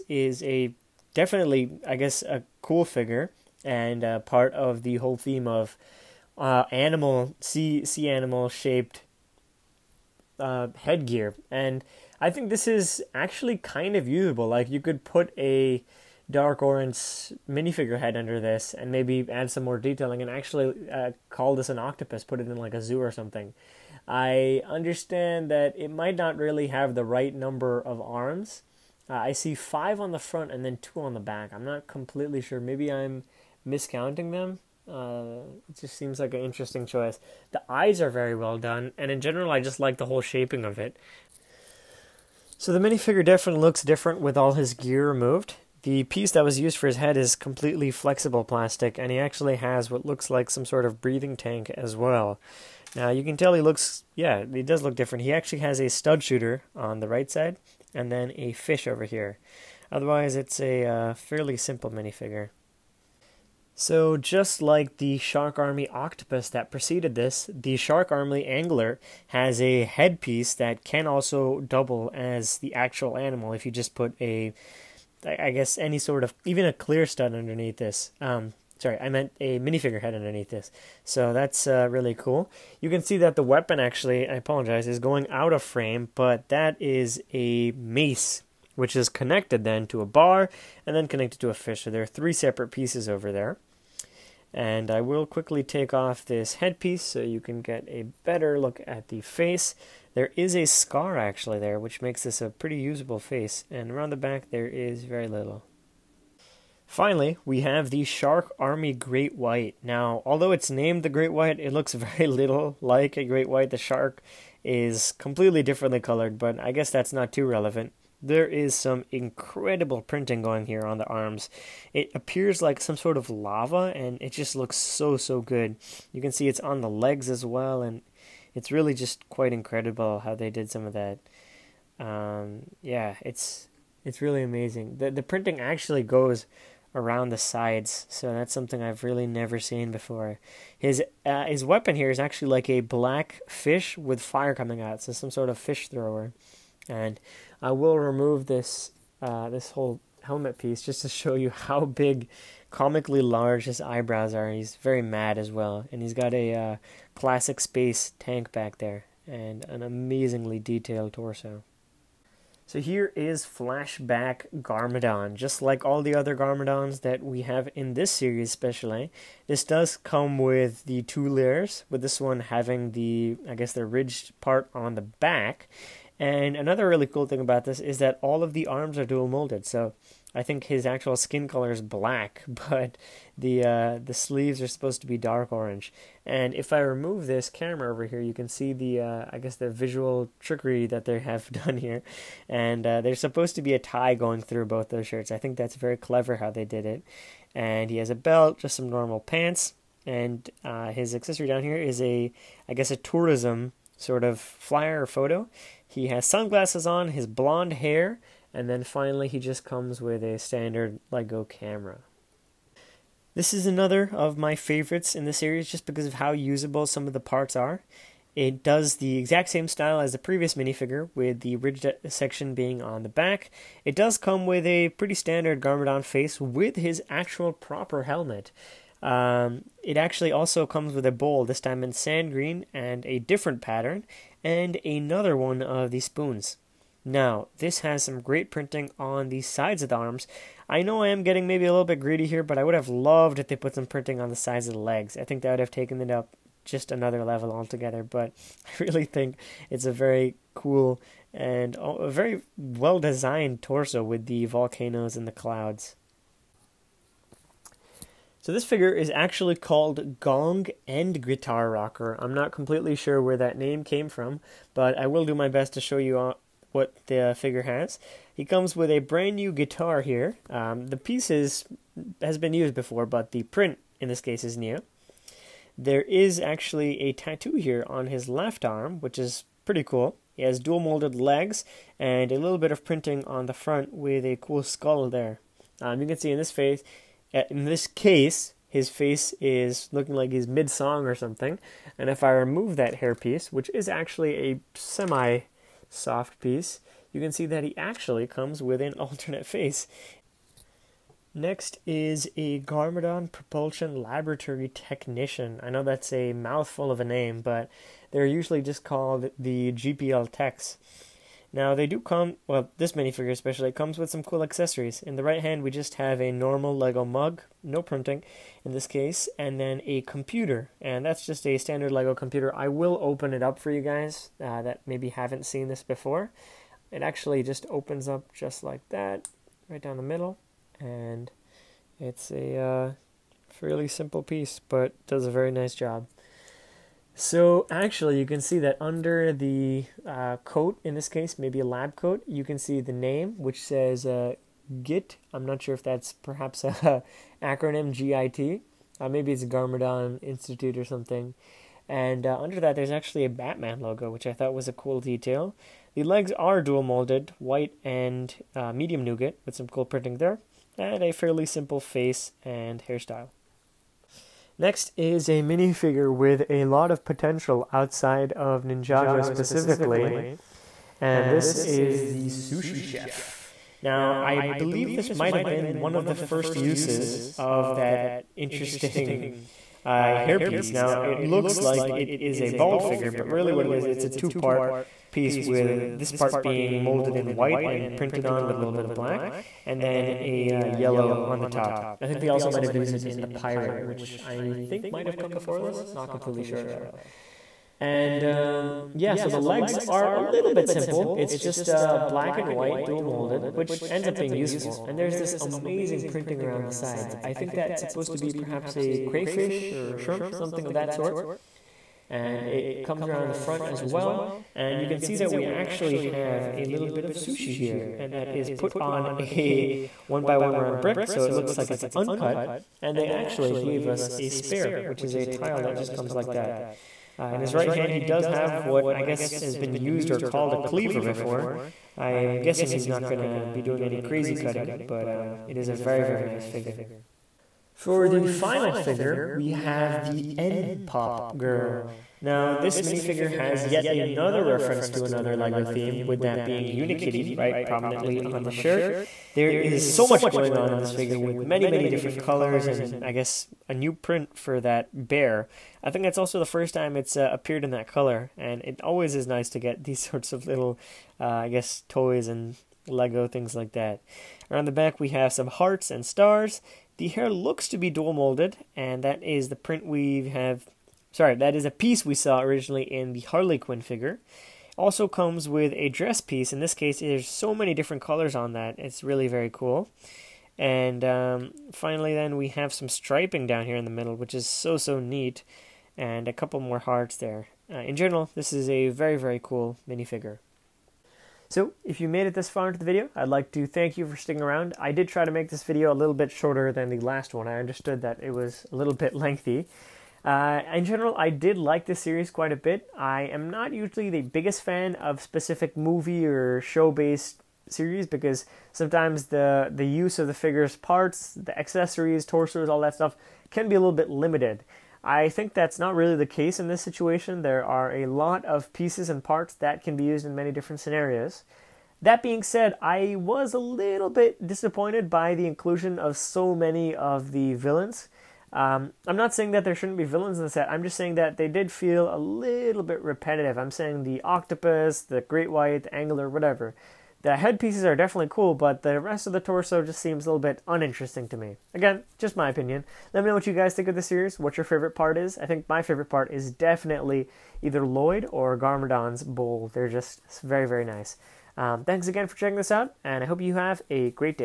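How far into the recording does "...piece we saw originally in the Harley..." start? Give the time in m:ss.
7:51.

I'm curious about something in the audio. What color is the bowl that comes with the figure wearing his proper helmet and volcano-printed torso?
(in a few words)
Sand green.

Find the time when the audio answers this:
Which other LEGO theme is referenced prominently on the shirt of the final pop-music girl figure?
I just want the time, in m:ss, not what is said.
7:26.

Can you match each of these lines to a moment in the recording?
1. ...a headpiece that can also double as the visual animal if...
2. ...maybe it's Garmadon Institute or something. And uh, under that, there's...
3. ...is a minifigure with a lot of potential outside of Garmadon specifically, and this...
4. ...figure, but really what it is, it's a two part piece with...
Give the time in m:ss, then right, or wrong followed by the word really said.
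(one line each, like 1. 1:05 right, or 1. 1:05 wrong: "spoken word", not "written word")
1. 1:09 wrong: "actual", not "visual"
2. 5:49 right
3. 6:04 wrong: "Ninjago", not "Garmadon"
4. 6:22 right.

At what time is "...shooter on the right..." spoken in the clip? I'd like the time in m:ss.
0:56.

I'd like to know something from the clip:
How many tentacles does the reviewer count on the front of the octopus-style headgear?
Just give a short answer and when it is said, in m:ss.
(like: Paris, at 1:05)
5, at 0:29.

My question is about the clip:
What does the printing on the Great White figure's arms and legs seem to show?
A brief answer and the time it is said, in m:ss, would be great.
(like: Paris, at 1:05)
Lava, at 2:03.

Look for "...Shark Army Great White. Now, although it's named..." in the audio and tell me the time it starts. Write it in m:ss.
1:48.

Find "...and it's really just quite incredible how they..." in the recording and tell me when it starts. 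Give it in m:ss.
2:07.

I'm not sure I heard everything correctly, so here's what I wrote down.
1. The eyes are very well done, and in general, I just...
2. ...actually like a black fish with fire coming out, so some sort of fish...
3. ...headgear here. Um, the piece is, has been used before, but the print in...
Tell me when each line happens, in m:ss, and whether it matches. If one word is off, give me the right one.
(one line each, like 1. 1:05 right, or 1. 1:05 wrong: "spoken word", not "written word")
1. 0:37 right
2. 2:22 right
3. 4:29 wrong: "guitar", not "headgear".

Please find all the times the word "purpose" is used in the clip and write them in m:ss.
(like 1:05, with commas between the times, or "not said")
not said.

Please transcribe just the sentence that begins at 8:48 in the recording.
Um, I'm not saying that there shouldn't be villains in the set.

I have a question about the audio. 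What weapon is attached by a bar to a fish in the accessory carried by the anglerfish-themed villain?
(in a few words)
A mace.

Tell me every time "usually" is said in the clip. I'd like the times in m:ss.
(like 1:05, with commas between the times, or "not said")
5:08, 8:23.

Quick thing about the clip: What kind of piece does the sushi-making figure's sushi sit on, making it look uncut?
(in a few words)
A one by one round brick.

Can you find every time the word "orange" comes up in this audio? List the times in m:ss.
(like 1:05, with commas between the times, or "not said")
0:16, 3:05.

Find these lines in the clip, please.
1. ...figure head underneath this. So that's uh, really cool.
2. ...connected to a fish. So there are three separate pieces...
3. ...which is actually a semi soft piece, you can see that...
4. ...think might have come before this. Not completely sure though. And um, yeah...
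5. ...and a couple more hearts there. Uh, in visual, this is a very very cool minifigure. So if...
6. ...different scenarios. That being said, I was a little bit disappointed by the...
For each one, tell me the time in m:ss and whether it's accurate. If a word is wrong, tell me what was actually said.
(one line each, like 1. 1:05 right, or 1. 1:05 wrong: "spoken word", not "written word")
1. 1:19 wrong: "minifigure", not "figure"
2. 1:31 right
3. 4:53 right
4. 6:34 right
5. 8:05 wrong: "general", not "visual"
6. 8:40 right.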